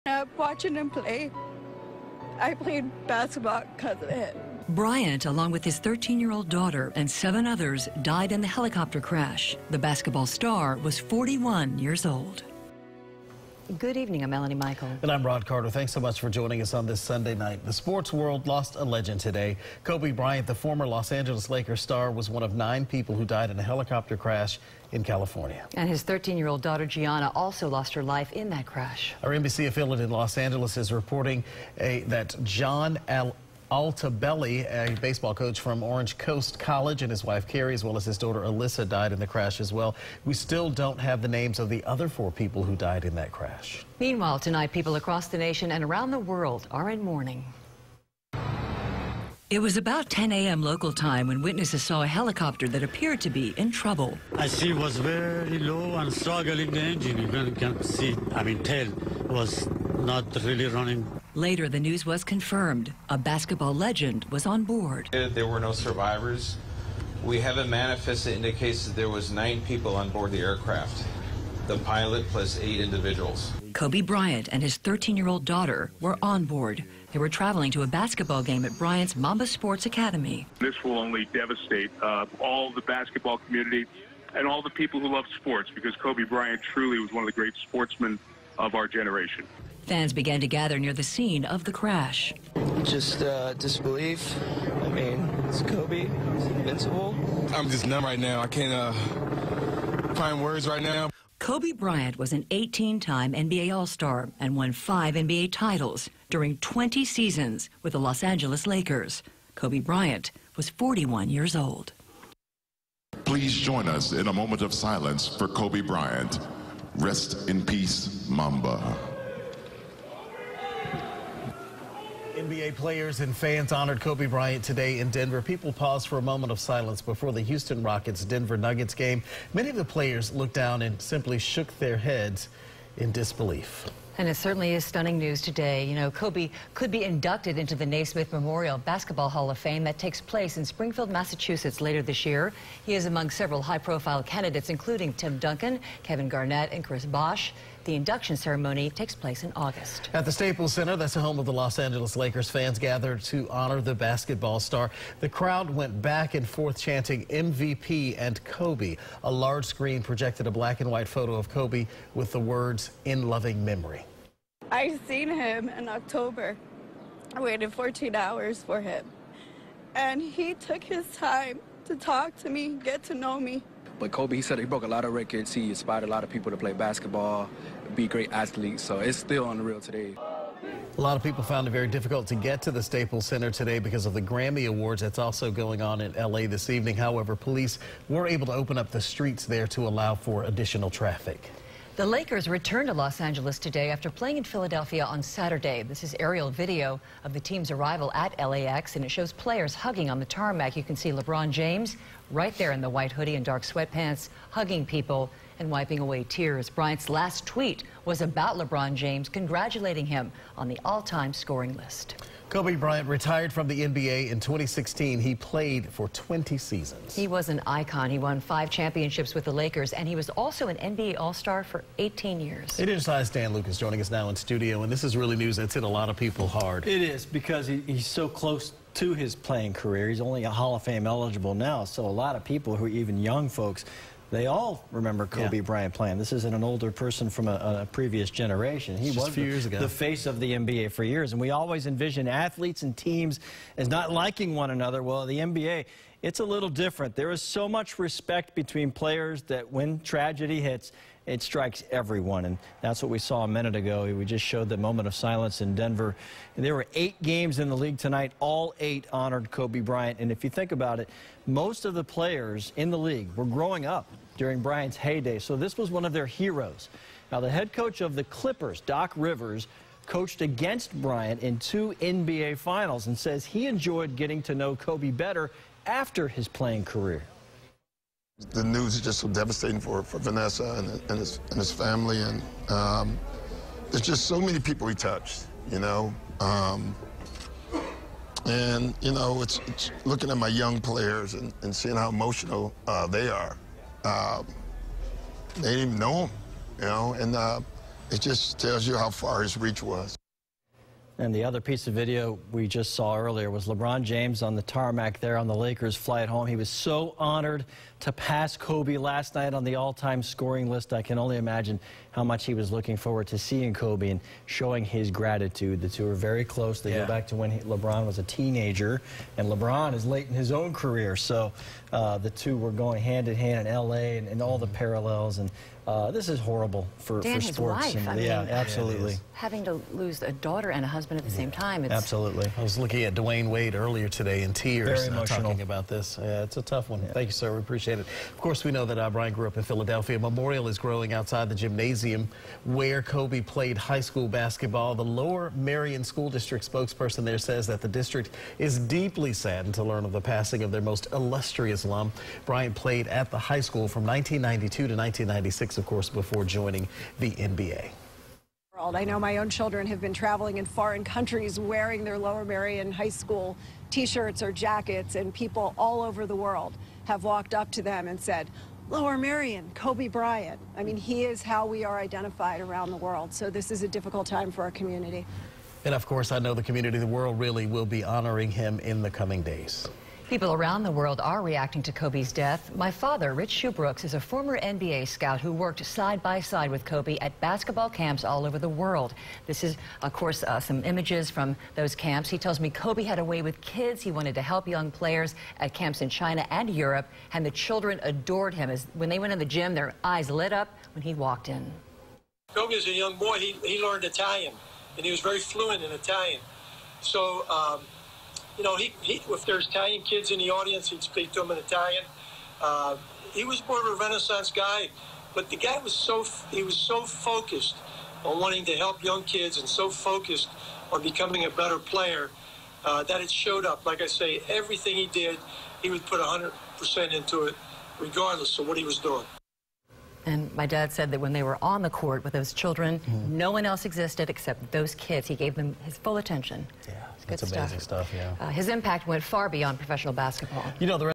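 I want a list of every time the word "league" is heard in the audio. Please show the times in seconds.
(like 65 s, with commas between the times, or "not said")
257 s, 262 s.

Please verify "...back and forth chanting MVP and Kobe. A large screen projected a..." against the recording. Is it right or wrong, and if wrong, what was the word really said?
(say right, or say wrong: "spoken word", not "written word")
right.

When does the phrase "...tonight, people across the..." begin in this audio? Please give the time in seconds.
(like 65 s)
44 s.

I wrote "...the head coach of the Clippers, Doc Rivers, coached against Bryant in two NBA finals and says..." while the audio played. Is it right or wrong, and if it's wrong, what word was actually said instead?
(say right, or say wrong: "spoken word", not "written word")
right.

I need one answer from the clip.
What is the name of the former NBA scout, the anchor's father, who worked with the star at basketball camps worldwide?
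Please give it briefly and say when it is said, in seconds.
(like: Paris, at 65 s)
Rich Sheubrooks, at 383 s.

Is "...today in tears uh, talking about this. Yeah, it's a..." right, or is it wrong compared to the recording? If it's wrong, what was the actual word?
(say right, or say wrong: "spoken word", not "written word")
right.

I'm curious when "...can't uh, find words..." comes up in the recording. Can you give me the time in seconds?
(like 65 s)
98 s.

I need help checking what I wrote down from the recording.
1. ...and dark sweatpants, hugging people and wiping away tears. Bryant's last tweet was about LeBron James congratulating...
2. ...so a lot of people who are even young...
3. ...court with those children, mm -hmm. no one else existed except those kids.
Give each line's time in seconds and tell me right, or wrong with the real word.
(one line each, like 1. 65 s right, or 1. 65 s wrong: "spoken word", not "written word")
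1. 203 s right
2. 231 s right
3. 431 s right.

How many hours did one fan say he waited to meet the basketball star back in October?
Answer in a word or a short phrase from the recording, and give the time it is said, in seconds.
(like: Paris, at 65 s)
14, at 167 s.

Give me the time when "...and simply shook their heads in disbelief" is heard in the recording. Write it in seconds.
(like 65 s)
130 s.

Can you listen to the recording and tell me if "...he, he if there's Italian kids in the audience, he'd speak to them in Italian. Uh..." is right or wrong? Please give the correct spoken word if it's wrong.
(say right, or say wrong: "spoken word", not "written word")
right.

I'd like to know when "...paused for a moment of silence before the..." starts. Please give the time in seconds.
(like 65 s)
125 s.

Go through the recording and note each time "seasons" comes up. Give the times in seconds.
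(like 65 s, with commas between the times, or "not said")
107 s, 216 s.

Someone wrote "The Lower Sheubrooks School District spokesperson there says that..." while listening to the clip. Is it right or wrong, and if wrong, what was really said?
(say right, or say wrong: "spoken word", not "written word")
wrong: "Merion", not "Sheubrooks".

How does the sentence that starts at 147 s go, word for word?
The induction ceremony takes place in August.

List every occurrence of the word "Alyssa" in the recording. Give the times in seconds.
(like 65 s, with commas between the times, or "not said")
38 s.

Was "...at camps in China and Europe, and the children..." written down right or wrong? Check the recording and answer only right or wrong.
right.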